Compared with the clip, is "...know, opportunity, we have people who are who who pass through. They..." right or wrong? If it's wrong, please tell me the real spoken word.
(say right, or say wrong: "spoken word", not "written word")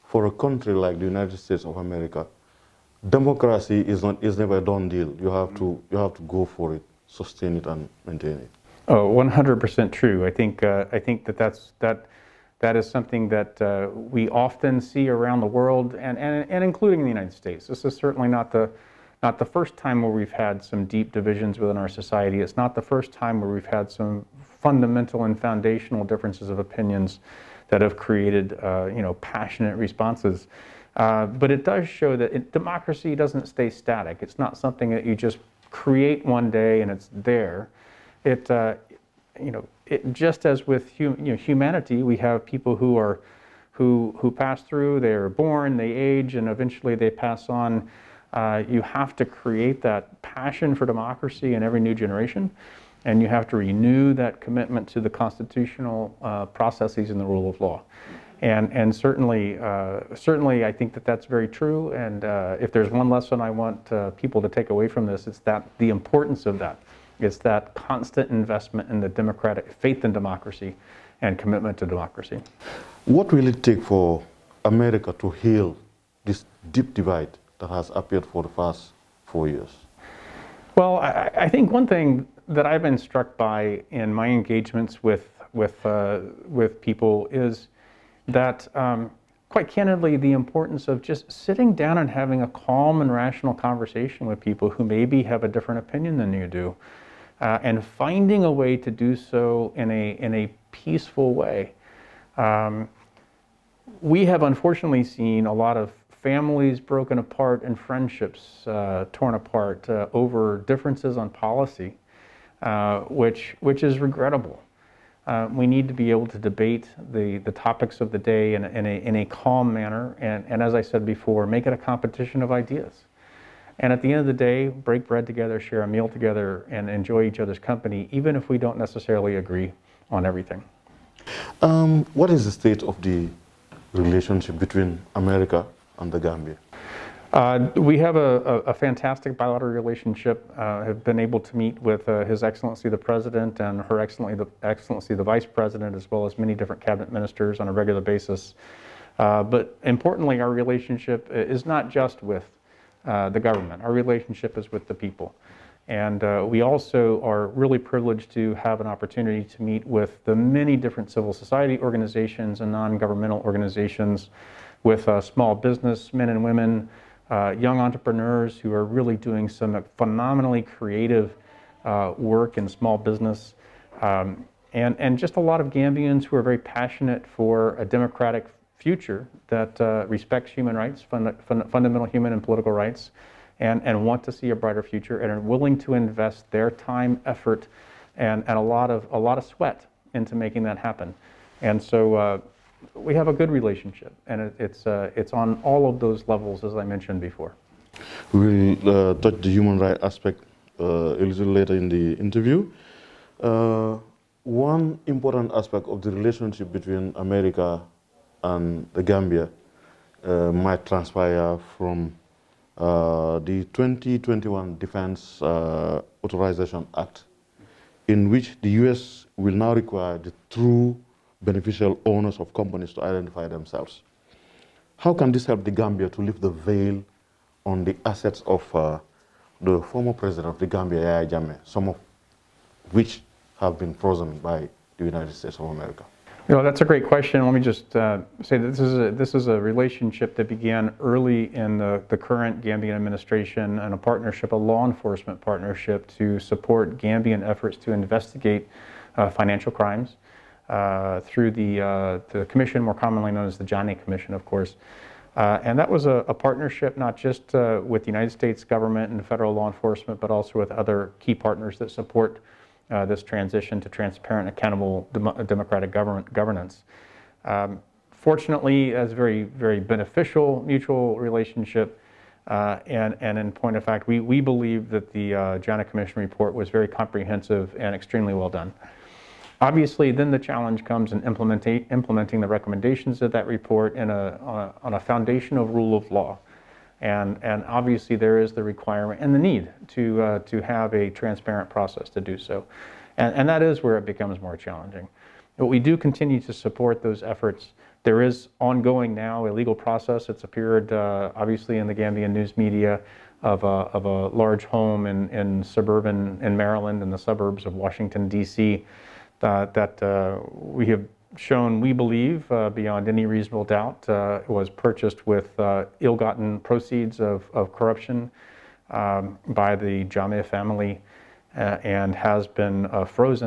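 wrong: "humanity", not "opportunity".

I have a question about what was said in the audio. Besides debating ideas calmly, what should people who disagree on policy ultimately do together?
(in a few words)
break bread.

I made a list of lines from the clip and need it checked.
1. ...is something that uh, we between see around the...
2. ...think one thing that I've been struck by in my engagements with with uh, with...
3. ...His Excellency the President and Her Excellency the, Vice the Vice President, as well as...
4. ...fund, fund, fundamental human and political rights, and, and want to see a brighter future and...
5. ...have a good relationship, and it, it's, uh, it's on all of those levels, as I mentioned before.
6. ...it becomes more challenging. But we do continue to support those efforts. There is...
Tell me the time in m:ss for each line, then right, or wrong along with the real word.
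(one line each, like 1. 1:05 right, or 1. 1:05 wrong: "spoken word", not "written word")
1. 0:12 wrong: "often", not "between"
2. 1:21 right
3. 2:22 wrong: "Excellency", not "Vice"
4. 3:01 right
5. 3:13 right
6. 4:53 right.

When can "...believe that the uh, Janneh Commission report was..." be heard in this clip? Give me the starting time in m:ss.
4:34.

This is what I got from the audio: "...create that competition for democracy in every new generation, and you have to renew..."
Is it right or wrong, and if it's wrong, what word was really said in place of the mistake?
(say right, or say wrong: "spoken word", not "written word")
wrong: "passion", not "competition".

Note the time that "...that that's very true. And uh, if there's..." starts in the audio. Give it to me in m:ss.
1:00.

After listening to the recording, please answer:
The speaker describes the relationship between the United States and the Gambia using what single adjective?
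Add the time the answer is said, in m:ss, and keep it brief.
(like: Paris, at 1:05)
fantastic, at 2:18.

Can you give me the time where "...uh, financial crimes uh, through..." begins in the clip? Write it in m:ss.
4:09.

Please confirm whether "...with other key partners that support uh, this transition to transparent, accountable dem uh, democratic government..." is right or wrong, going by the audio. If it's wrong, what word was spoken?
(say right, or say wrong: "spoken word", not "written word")
right.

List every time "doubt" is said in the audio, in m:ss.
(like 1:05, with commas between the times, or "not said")
5:13.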